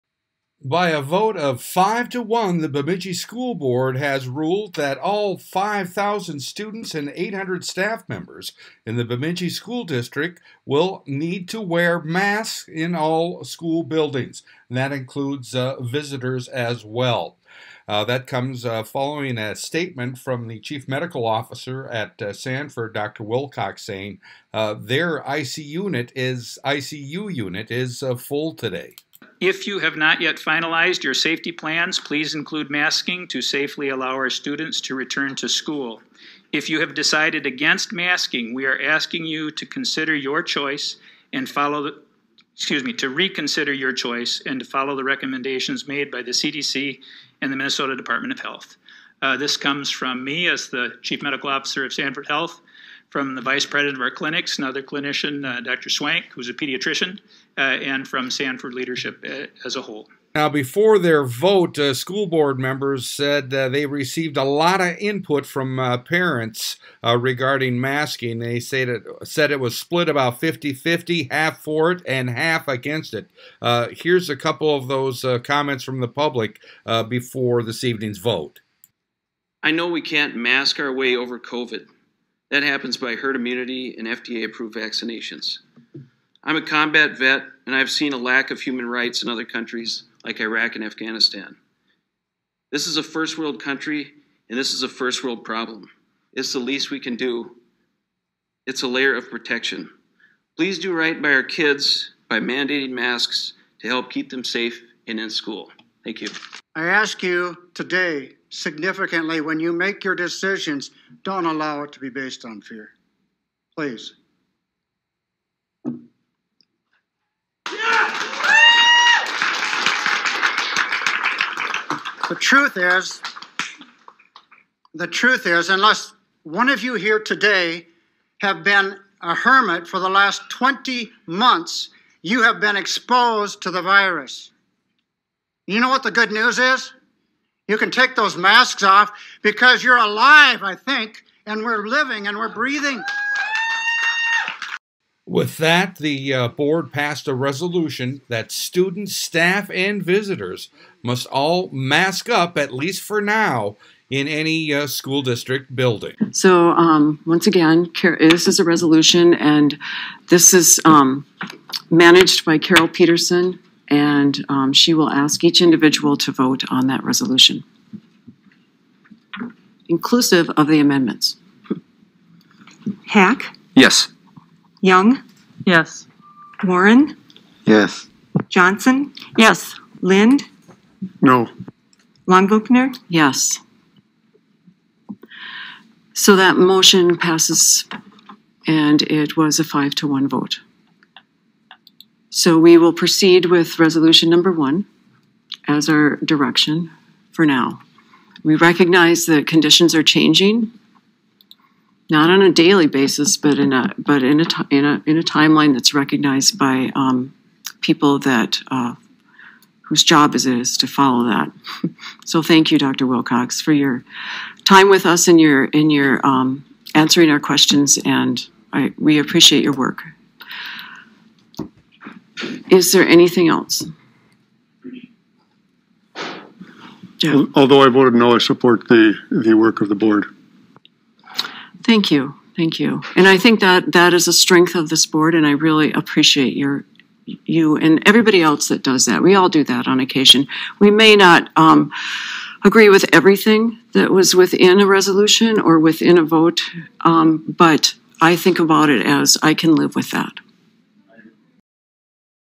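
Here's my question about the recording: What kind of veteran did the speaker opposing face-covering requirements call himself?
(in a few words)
Combat.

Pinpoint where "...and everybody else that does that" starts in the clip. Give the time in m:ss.
3:57.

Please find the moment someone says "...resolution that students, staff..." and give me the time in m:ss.
2:27.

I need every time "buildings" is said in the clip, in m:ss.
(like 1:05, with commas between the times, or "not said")
0:13, 2:35.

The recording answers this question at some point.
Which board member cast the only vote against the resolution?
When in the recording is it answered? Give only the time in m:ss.
3:00.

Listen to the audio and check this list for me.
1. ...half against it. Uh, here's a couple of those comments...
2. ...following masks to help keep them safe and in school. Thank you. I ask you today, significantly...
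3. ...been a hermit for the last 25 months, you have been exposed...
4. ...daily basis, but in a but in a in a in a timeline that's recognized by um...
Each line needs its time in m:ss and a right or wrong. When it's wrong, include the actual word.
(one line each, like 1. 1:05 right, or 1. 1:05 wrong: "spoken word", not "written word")
1. 1:12 right
2. 1:42 wrong: "mandating", not "following"
3. 2:08 wrong: "20", not "25"
4. 3:22 right.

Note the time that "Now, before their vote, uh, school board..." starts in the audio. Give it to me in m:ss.
1:00.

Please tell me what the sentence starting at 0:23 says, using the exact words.
Wilcox, saying uh, their ICU unit is ICU unit is uh, full today.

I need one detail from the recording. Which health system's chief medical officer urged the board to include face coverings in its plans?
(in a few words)
Sanford Health.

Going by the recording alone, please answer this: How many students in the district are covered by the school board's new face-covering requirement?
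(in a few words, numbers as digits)
5,000.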